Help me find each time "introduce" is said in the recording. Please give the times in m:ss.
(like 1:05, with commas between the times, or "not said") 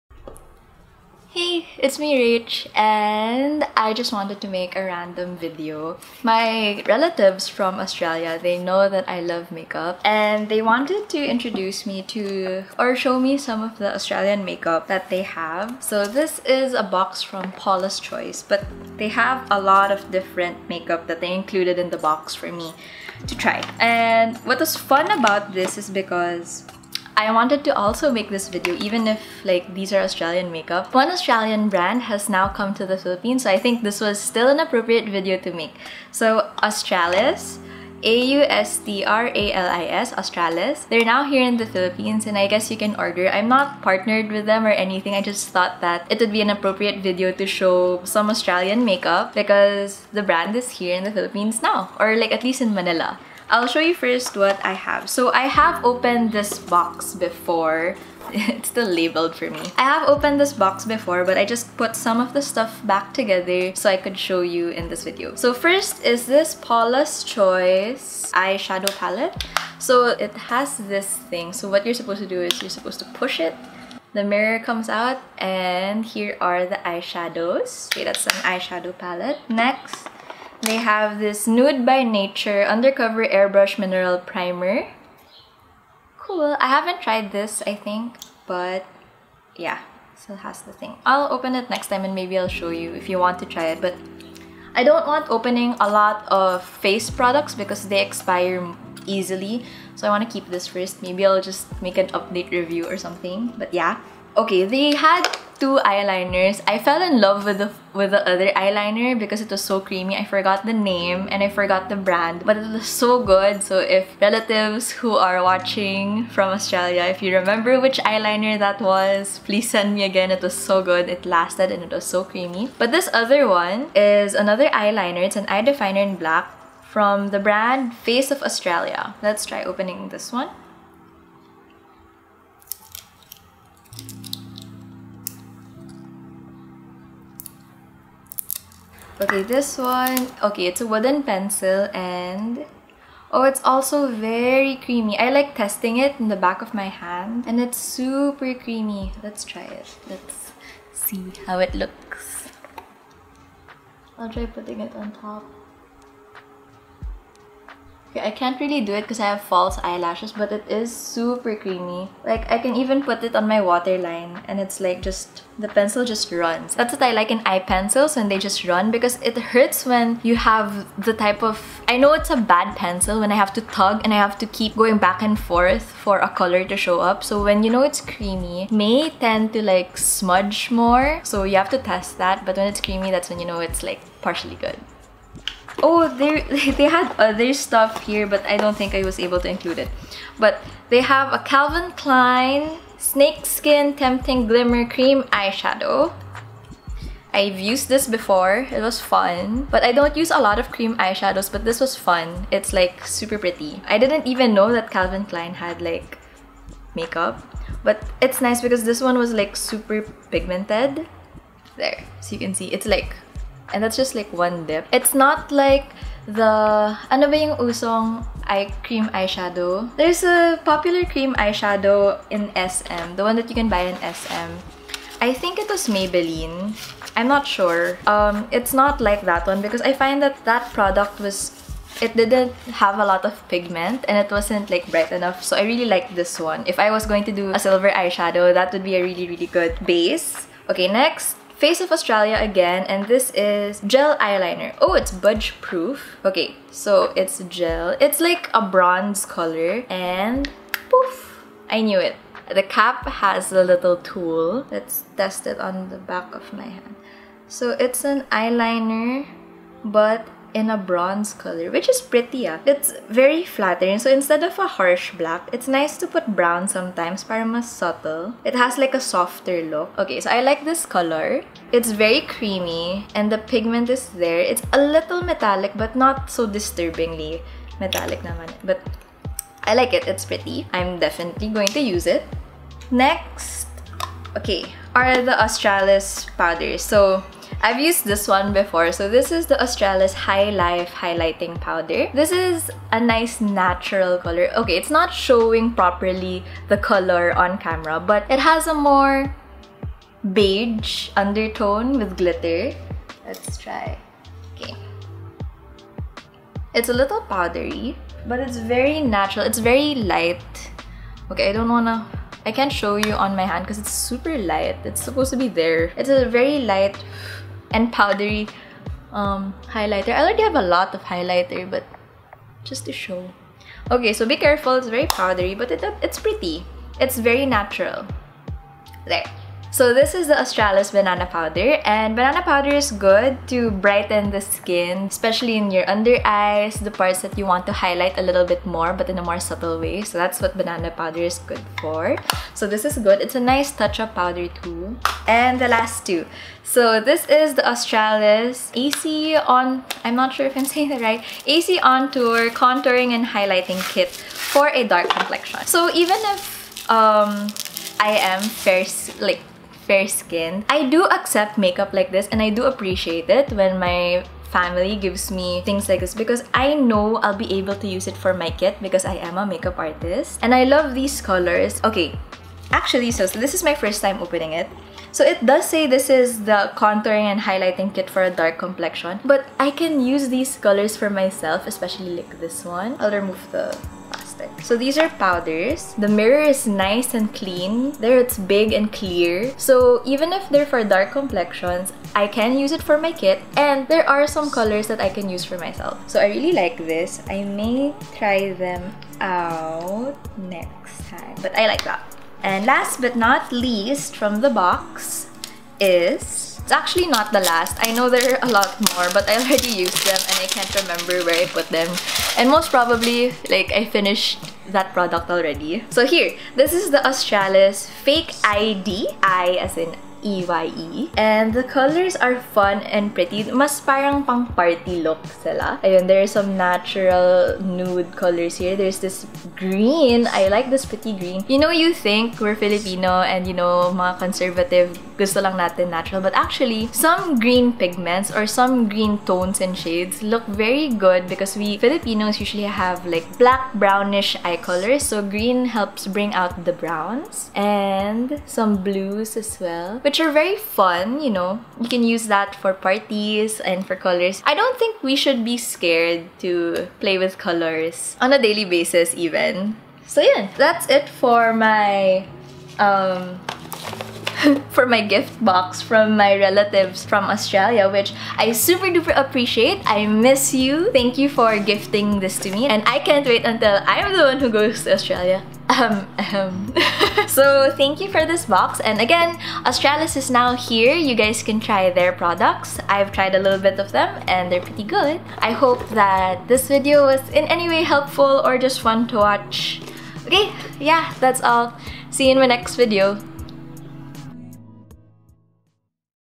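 0:11.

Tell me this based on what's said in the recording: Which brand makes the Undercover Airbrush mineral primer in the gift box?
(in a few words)
Nude by Nature.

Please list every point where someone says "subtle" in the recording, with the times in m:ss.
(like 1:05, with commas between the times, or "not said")
4:27, 5:39.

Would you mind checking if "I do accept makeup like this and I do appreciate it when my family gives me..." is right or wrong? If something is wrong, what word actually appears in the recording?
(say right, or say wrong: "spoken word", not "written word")
right.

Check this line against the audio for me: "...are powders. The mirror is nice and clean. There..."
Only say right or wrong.
right.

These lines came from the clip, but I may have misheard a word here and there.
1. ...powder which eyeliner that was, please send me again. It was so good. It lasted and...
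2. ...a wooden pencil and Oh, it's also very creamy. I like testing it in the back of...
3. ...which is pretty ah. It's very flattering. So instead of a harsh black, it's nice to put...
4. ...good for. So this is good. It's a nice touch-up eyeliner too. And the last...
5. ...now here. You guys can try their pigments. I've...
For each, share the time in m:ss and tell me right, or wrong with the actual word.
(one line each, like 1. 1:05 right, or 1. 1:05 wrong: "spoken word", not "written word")
1. 1:57 wrong: "remember", not "powder"
2. 2:20 right
3. 4:21 right
4. 5:41 wrong: "powder", not "eyeliner"
5. 8:00 wrong: "products", not "pigments".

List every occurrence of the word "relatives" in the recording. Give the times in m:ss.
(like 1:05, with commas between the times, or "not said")
0:06, 1:54, 7:46.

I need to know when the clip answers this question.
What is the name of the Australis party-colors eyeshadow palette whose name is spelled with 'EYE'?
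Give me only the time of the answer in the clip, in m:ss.
6:57.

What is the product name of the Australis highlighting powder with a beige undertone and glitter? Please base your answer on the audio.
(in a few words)
High Life.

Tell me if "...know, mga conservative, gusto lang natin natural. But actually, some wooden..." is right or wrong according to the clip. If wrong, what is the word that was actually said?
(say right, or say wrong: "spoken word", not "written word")
wrong: "green", not "wooden".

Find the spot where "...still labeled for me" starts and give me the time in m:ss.
0:58.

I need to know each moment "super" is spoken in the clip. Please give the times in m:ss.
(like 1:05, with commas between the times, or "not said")
2:27, 2:40, 3:23, 3:29, 5:13, 7:48.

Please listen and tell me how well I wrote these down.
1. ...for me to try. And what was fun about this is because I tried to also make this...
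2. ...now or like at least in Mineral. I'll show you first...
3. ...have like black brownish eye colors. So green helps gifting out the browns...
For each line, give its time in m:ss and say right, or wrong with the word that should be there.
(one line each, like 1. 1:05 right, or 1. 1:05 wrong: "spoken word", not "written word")
1. 0:22 wrong: "wanted", not "tried"
2. 0:51 wrong: "Manila", not "Mineral"
3. 7:22 wrong: "bring", not "gifting".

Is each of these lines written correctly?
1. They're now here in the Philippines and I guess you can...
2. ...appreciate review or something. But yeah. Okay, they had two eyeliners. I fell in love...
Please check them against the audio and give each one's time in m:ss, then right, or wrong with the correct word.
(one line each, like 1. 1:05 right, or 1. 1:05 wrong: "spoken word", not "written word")
1. 0:40 right
2. 1:42 wrong: "update", not "appreciate".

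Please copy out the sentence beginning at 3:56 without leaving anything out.
If I was going to do a silver eyeshadow that would be a really really good base.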